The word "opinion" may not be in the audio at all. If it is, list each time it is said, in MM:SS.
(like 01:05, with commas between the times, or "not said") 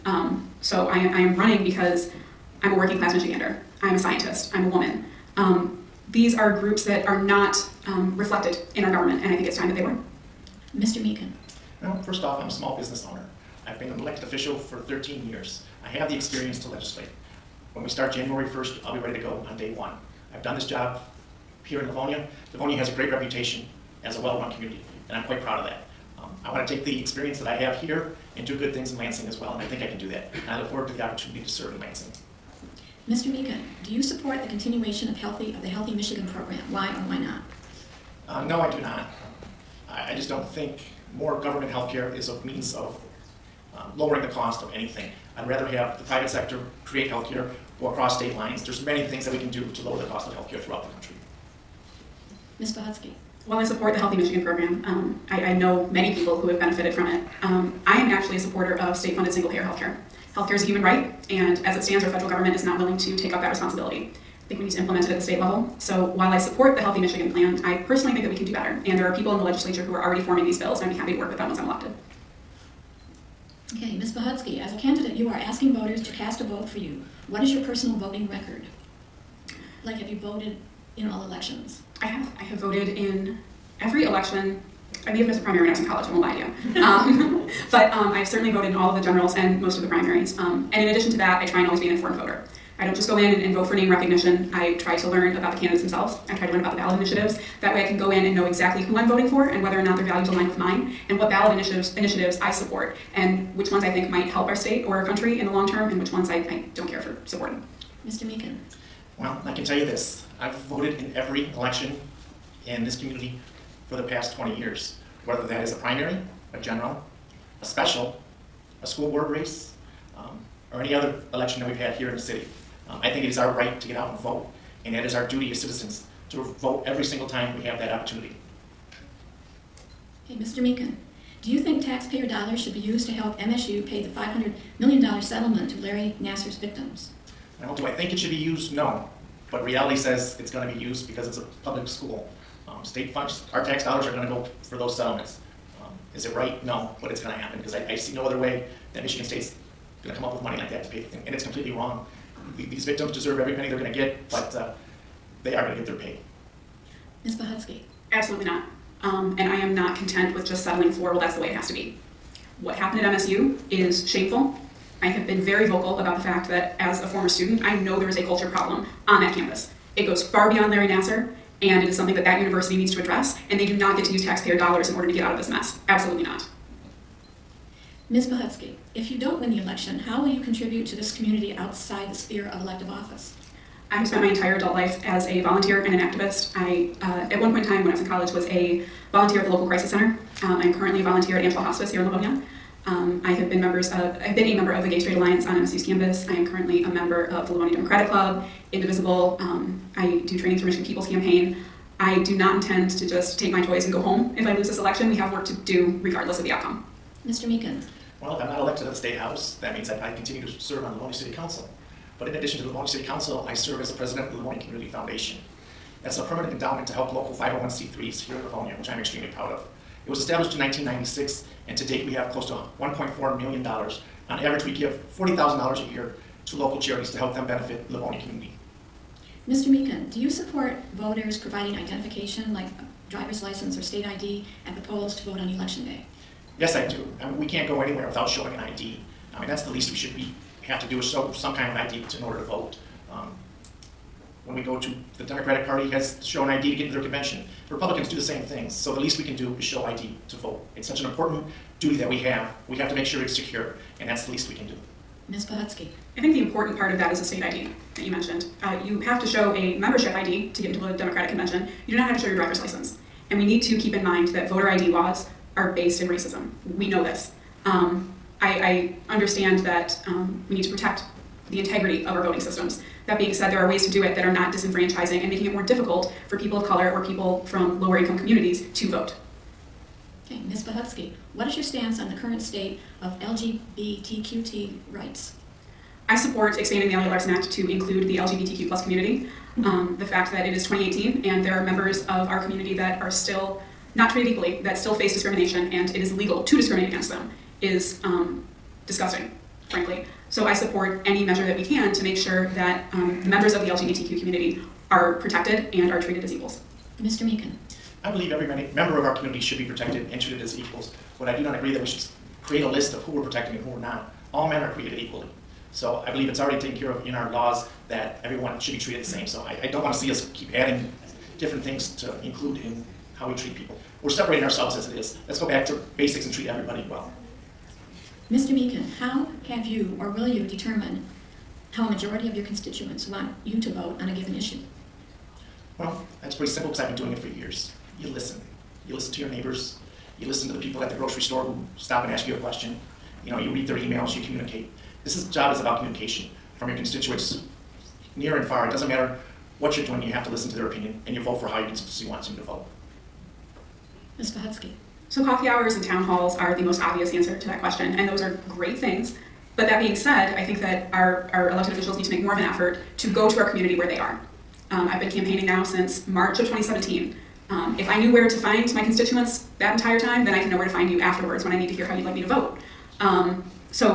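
05:50.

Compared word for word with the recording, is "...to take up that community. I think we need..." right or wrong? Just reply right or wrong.
wrong.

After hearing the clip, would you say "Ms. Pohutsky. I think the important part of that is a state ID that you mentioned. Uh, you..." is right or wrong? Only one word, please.
right.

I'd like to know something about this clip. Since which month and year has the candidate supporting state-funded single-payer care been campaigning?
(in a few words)
March 2017.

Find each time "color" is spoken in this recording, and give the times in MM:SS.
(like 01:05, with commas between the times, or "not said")
04:36.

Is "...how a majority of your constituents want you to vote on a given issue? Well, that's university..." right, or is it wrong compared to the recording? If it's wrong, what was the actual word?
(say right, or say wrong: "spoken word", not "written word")
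wrong: "pretty", not "university".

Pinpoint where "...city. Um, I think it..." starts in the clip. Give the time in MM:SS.
02:02.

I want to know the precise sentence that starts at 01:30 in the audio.
Um, and in addition to that, I try and always be an informed voter.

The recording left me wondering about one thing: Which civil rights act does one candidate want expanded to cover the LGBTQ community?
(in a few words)
Elliott-Larsen Act.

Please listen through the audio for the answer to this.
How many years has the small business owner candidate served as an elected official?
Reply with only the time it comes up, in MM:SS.
00:14.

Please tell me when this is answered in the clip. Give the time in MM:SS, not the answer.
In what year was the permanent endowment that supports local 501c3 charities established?
03:40.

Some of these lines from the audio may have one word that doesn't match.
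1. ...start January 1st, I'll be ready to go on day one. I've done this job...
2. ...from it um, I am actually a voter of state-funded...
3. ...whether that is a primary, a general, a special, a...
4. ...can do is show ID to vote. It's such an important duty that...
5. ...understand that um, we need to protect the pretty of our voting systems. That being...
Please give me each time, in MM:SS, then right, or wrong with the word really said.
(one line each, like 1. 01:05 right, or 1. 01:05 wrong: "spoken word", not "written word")
1. 00:17 right
2. 00:56 wrong: "supporter", not "voter"
3. 01:55 right
4. 04:09 right
5. 04:29 wrong: "integrity", not "pretty".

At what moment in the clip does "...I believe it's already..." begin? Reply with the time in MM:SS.
05:16.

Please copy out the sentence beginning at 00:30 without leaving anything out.
And I look forward to the opportunity to serve in Lansing.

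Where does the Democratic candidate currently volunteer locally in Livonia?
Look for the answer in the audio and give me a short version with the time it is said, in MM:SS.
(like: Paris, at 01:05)
Angela Hospice, at 03:11.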